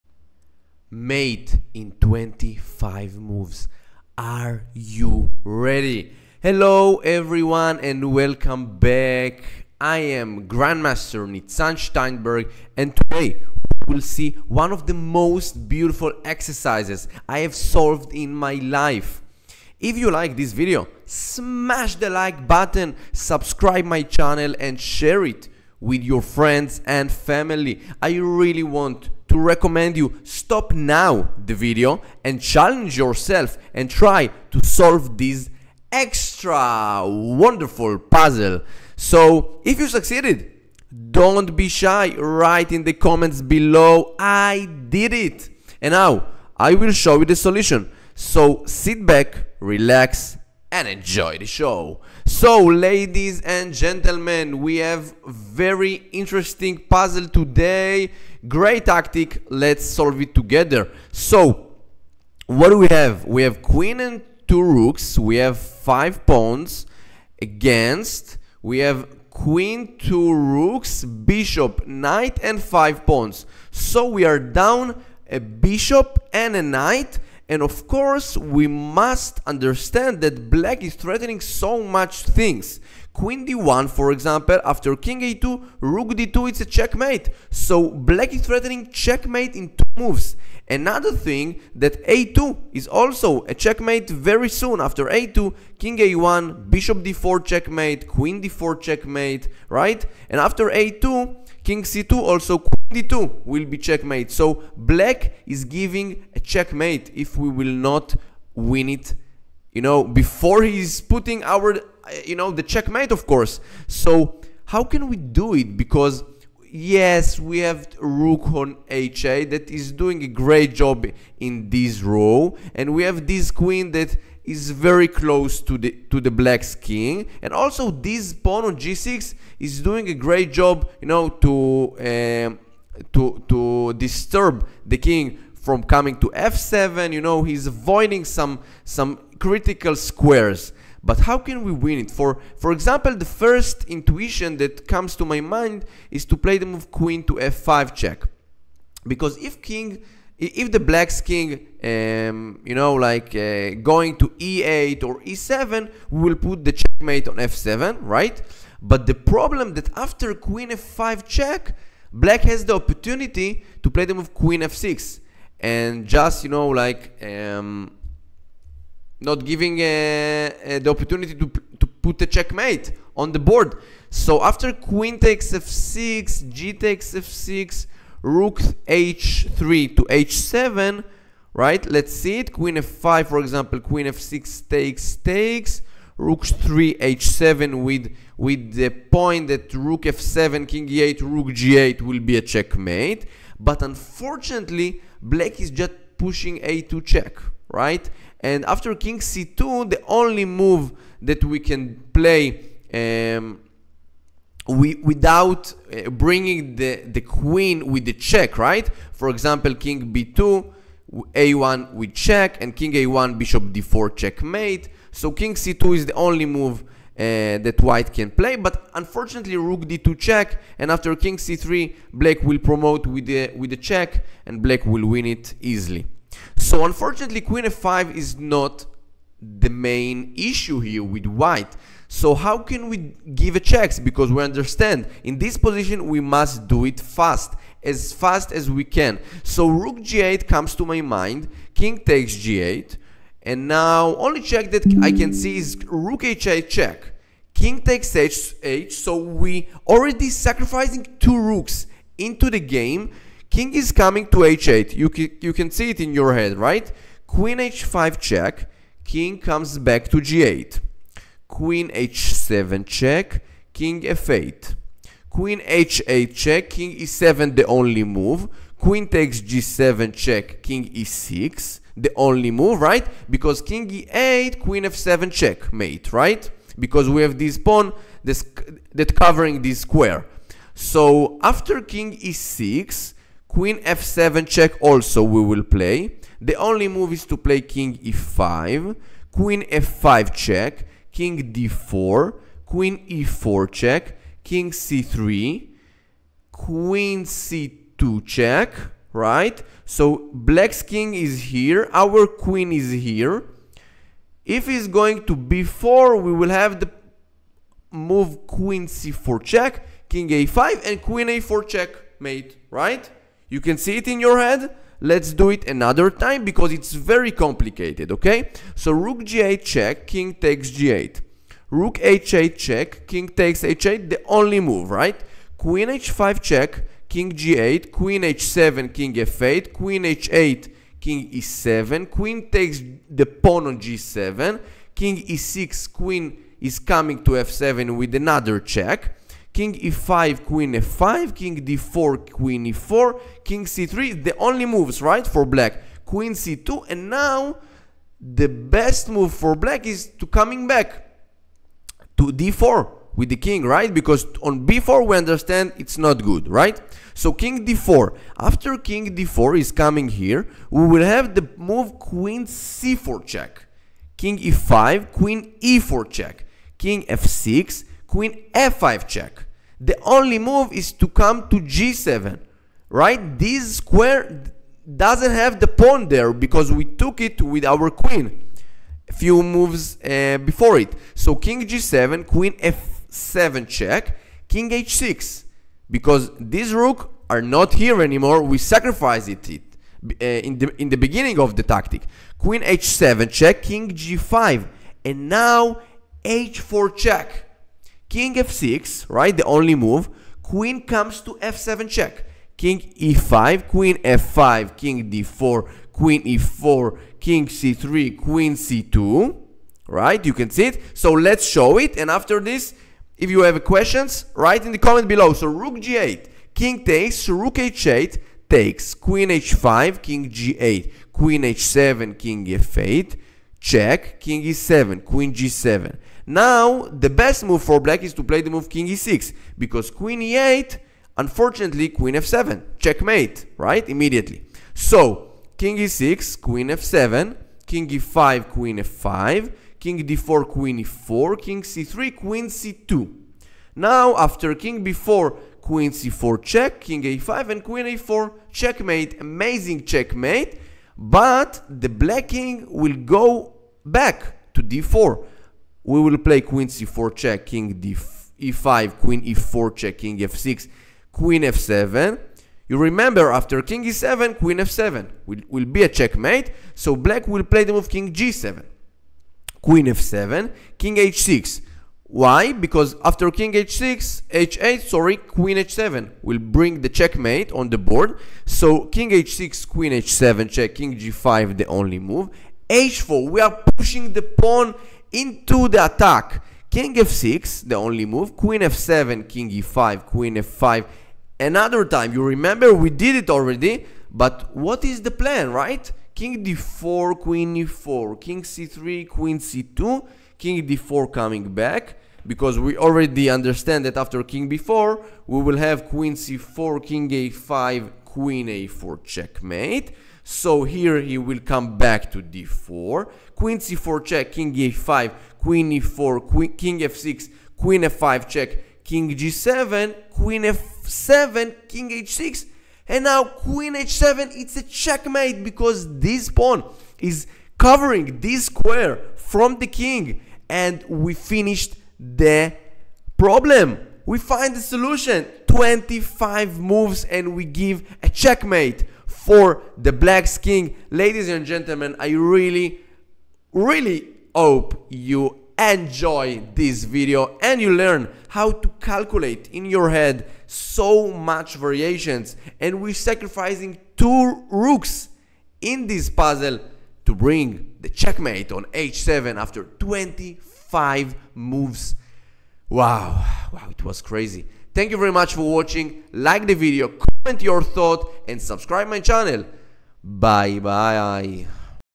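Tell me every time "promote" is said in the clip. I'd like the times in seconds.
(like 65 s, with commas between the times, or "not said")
222 s.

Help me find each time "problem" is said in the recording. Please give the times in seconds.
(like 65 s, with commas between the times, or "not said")
159 s, 533 s.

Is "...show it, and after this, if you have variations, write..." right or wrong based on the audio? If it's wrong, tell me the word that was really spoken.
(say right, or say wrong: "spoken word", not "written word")
wrong: "questions", not "variations".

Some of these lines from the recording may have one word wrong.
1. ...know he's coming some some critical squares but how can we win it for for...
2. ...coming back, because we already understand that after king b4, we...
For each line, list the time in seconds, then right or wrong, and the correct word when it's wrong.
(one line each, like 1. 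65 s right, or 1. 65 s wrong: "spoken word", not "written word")
1. 137 s wrong: "avoiding", not "coming"
2. 501 s right.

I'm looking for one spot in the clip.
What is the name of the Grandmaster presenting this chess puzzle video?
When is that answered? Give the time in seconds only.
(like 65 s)
11 s.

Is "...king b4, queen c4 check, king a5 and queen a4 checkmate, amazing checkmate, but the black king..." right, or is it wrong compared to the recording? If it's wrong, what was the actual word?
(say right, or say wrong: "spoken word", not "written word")
right.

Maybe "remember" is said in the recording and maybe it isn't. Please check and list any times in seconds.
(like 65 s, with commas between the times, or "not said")
462 s, 492 s.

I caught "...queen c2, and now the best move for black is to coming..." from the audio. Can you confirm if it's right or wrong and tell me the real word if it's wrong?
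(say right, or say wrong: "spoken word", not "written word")
right.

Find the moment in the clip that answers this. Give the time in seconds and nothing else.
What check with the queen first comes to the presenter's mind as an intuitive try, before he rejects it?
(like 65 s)
146 s.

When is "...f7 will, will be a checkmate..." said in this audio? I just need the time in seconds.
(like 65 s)
464 s.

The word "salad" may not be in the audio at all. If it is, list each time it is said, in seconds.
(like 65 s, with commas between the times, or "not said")
not said.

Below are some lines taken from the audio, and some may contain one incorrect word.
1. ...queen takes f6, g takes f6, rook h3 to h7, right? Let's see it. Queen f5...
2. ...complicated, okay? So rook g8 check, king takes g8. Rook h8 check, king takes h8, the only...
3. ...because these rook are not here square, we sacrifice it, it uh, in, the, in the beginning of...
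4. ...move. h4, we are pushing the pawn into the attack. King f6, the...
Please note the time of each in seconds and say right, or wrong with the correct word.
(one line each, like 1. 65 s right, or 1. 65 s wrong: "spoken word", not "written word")
1. 174 s right
2. 317 s right
3. 385 s wrong: "anymore", not "square"
4. 481 s right.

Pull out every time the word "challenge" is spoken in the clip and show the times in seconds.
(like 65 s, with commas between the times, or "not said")
32 s.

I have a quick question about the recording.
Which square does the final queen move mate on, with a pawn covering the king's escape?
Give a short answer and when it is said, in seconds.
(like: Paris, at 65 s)
h7, at 523 s.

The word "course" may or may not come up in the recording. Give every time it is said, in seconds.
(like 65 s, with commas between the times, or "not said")
77 s, 113 s.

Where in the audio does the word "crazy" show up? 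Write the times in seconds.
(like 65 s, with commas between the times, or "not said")
564 s.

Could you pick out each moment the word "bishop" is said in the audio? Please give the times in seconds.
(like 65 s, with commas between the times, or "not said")
71 s, 75 s, 96 s, 213 s.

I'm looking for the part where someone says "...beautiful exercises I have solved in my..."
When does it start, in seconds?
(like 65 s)
15 s.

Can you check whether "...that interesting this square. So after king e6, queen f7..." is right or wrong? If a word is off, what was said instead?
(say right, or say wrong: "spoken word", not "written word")
wrong: "covering", not "interesting".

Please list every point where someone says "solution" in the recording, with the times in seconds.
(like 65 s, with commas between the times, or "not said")
47 s, 534 s.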